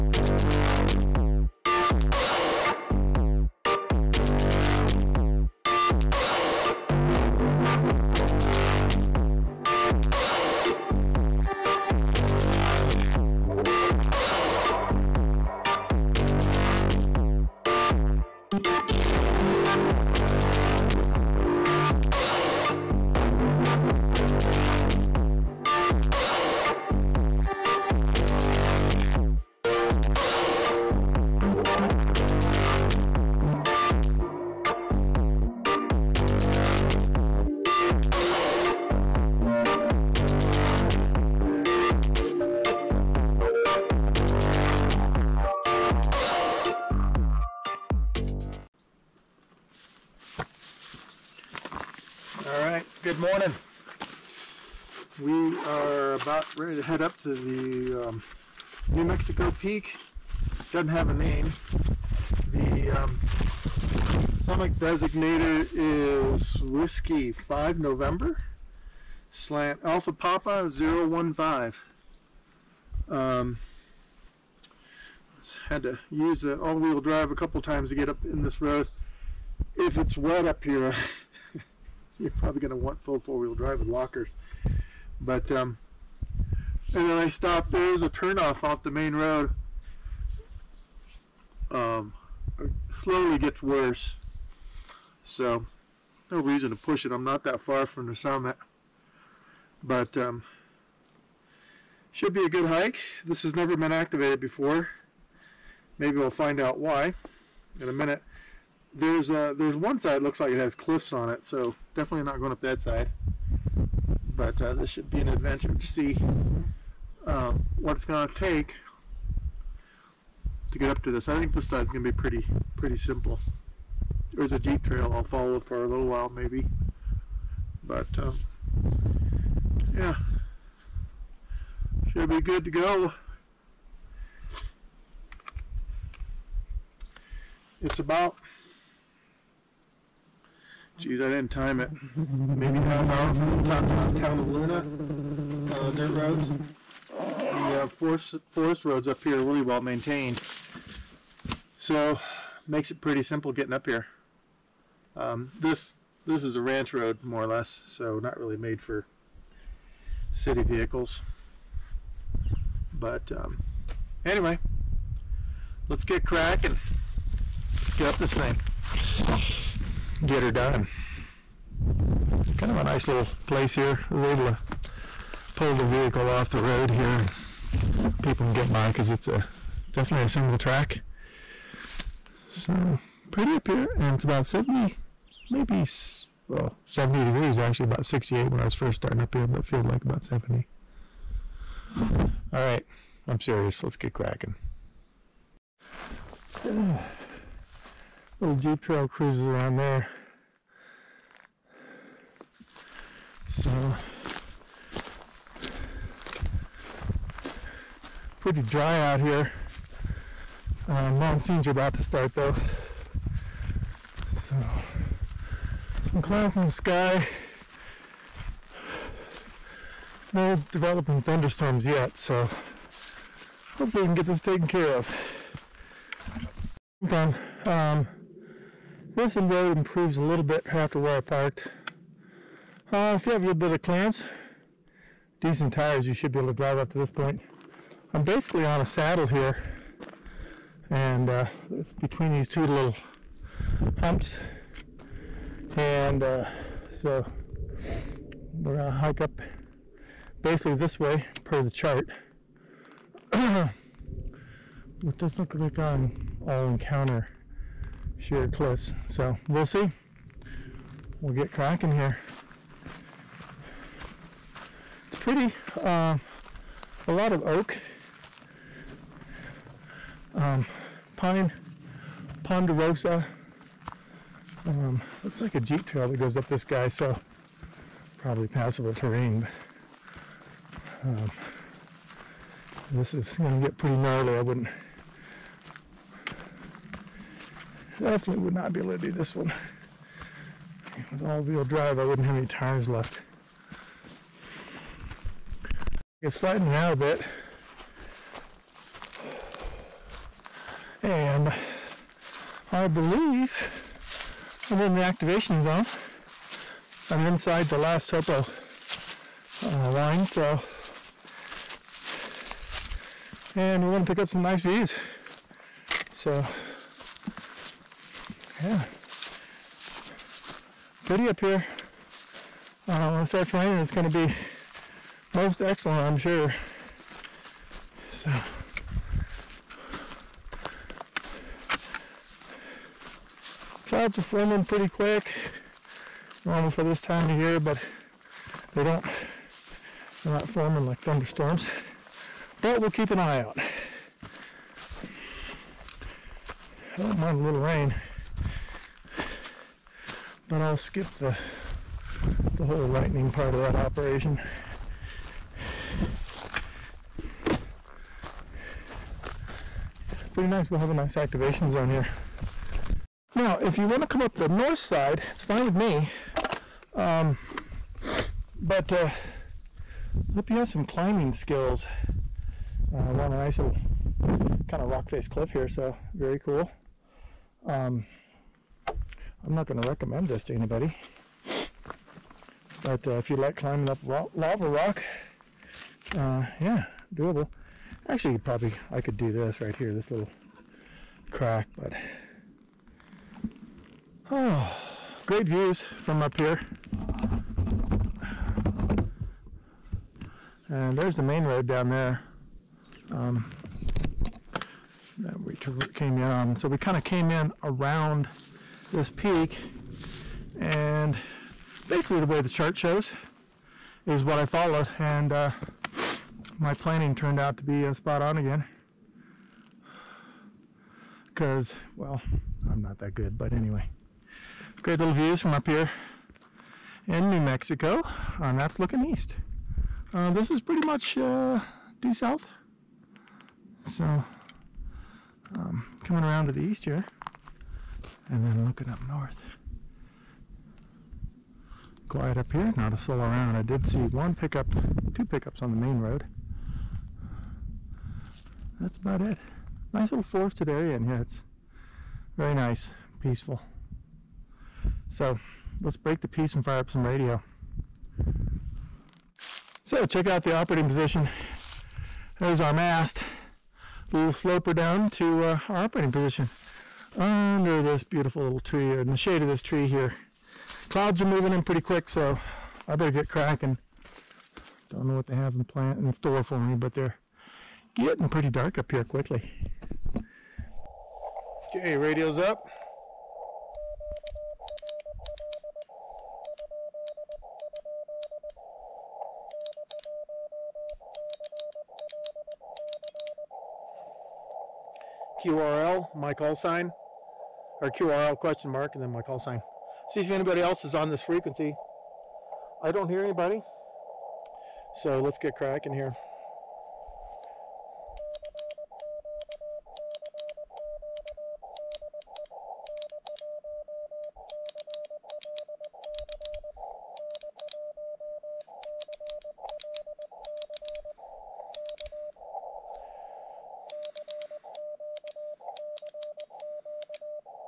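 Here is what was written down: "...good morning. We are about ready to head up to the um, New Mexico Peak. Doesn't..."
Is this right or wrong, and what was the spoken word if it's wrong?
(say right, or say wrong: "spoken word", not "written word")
right.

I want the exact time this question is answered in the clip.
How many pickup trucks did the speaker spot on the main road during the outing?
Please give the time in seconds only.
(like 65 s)
445 s.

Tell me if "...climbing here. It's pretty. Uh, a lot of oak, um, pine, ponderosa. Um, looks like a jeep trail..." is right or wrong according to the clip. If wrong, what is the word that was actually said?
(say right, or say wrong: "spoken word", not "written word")
wrong: "cracking", not "climbing".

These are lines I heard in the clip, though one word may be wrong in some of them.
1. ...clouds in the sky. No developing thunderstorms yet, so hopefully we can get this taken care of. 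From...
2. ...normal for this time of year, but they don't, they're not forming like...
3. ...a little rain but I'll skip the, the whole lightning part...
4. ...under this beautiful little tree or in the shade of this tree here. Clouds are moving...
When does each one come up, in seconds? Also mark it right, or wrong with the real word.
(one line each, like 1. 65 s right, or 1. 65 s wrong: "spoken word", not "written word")
1. 216 s right
2. 336 s right
3. 347 s right
4. 467 s right.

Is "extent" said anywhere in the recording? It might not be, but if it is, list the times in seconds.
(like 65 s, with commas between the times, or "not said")
not said.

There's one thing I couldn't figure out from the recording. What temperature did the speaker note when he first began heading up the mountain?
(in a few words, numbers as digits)
68 degrees.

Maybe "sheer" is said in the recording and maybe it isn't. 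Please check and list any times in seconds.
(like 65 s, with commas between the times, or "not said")
258 s.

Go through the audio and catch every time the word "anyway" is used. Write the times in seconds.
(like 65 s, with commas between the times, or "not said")
164 s, 423 s.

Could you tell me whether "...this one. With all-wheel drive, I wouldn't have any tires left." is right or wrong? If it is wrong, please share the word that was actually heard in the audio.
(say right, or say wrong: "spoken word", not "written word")
right.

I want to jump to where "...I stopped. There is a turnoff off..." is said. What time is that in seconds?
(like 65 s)
87 s.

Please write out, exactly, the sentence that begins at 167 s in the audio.
Get up this thing get her done.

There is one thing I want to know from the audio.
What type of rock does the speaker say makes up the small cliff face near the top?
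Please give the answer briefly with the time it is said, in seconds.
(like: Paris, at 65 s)
Lava rock, at 384 s.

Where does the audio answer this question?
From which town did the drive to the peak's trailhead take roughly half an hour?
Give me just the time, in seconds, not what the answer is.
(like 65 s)
144 s.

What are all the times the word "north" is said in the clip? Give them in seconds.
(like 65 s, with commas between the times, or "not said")
364 s, 439 s.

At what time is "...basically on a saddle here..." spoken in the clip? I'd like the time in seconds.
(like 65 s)
238 s.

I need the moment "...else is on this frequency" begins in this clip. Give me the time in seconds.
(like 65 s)
500 s.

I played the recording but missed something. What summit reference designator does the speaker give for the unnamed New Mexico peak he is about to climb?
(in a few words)
W5N/AP-015.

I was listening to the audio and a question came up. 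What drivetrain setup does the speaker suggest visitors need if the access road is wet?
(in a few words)
Full four-wheel drive with lockers.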